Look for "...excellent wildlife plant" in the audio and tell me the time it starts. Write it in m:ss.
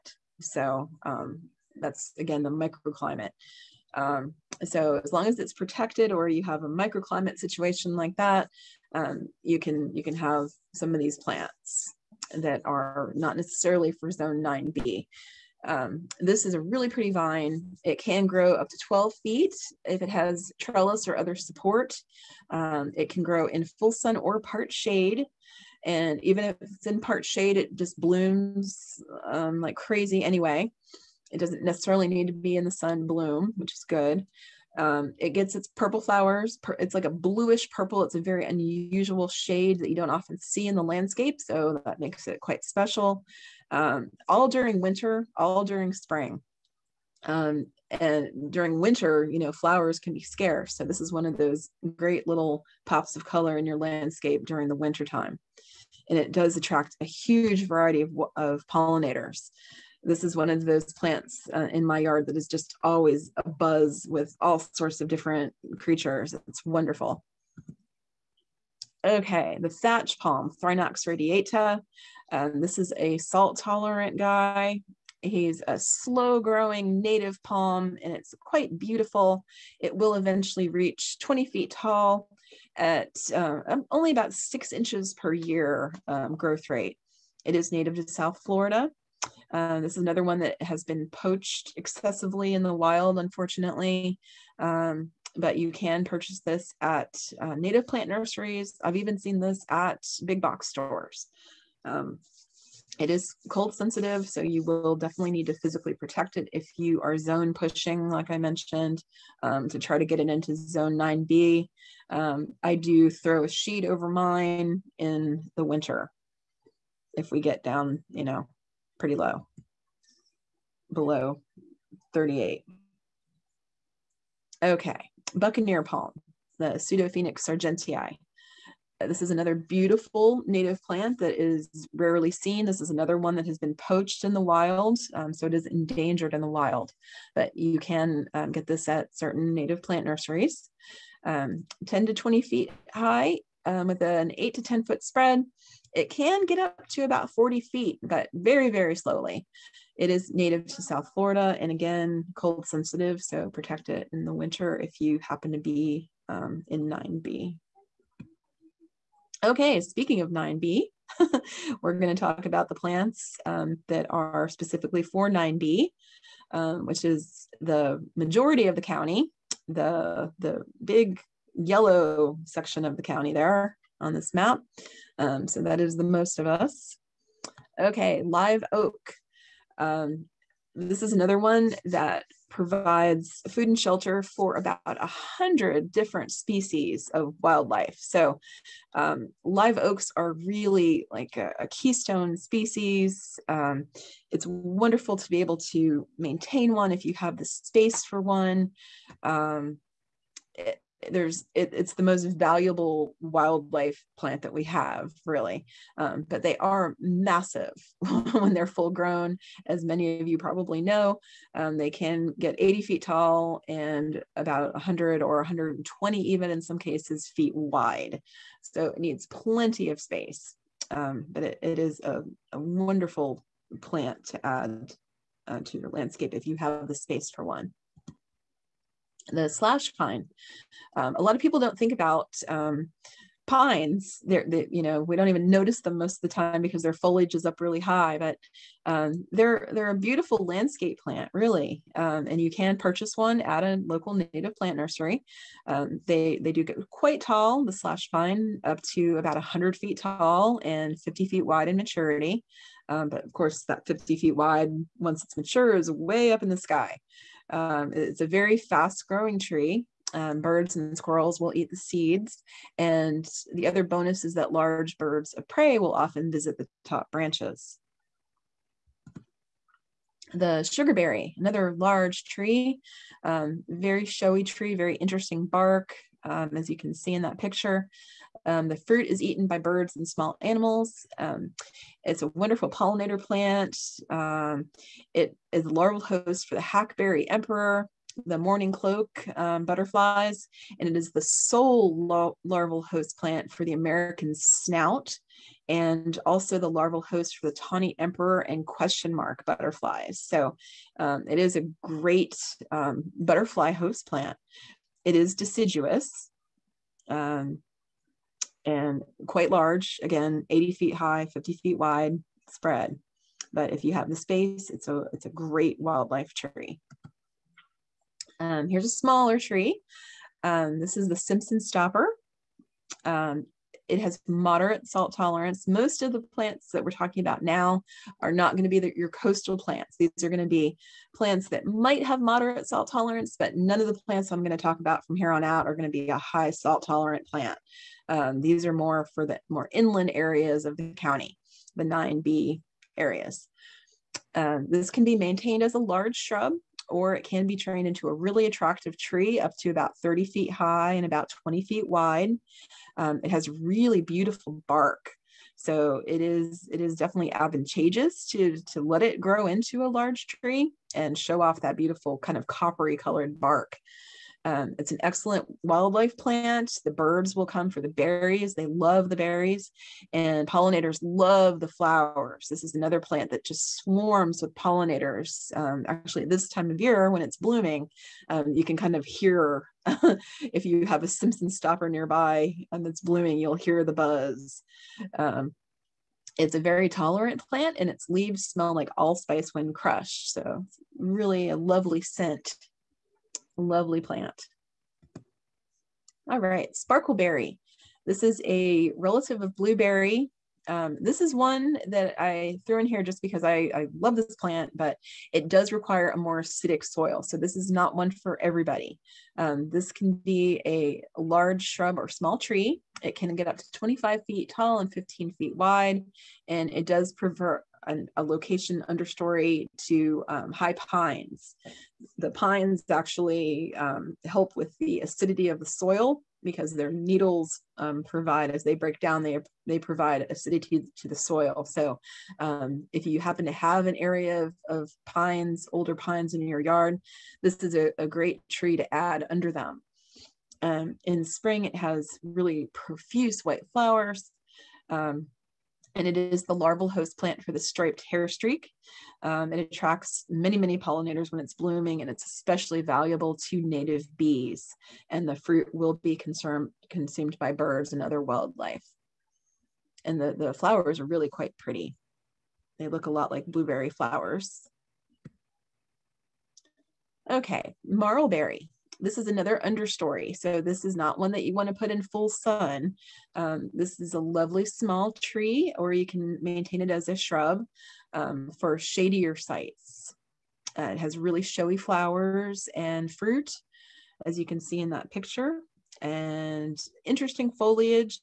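6:05.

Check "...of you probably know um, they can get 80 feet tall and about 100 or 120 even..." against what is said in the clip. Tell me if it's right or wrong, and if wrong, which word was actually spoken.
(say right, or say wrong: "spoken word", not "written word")
right.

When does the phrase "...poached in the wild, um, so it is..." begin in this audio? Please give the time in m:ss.
2:13.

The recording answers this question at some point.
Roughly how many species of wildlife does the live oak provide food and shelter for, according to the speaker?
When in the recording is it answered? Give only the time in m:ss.
3:04.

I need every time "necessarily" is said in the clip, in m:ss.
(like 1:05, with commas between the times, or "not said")
0:13, 0:31.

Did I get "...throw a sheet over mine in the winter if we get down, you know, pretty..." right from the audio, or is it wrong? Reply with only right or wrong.
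right.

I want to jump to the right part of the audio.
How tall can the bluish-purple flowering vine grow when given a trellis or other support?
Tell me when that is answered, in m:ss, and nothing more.
0:18.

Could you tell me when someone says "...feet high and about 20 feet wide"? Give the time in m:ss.
5:50.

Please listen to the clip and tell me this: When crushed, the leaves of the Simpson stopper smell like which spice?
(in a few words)
allspice.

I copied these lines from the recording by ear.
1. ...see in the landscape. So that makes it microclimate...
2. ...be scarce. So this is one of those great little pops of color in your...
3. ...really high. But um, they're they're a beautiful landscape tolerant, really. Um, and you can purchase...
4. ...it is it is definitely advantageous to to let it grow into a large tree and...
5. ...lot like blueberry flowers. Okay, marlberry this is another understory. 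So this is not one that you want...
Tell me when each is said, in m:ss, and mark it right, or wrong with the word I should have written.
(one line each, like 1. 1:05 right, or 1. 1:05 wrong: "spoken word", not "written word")
1. 0:40 wrong: "quite", not "microclimate"
2. 0:50 right
3. 3:57 wrong: "plant", not "tolerant"
4. 5:56 right
5. 7:43 right.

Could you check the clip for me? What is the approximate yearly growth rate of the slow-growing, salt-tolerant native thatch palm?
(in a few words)
6 inches per year.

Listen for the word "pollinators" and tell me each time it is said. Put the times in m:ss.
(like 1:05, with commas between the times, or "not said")
0:58, 4:42, 6:10, 6:14, 7:30.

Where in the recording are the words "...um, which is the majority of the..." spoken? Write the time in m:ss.
2:46.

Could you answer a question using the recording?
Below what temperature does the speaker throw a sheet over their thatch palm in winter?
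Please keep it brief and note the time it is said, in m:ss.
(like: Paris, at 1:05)
38, at 2:02.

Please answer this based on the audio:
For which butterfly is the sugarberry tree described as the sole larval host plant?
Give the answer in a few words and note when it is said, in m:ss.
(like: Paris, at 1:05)
American snout, at 4:53.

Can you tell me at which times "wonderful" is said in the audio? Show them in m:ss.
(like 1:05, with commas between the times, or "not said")
1:06, 3:14, 3:42, 4:42.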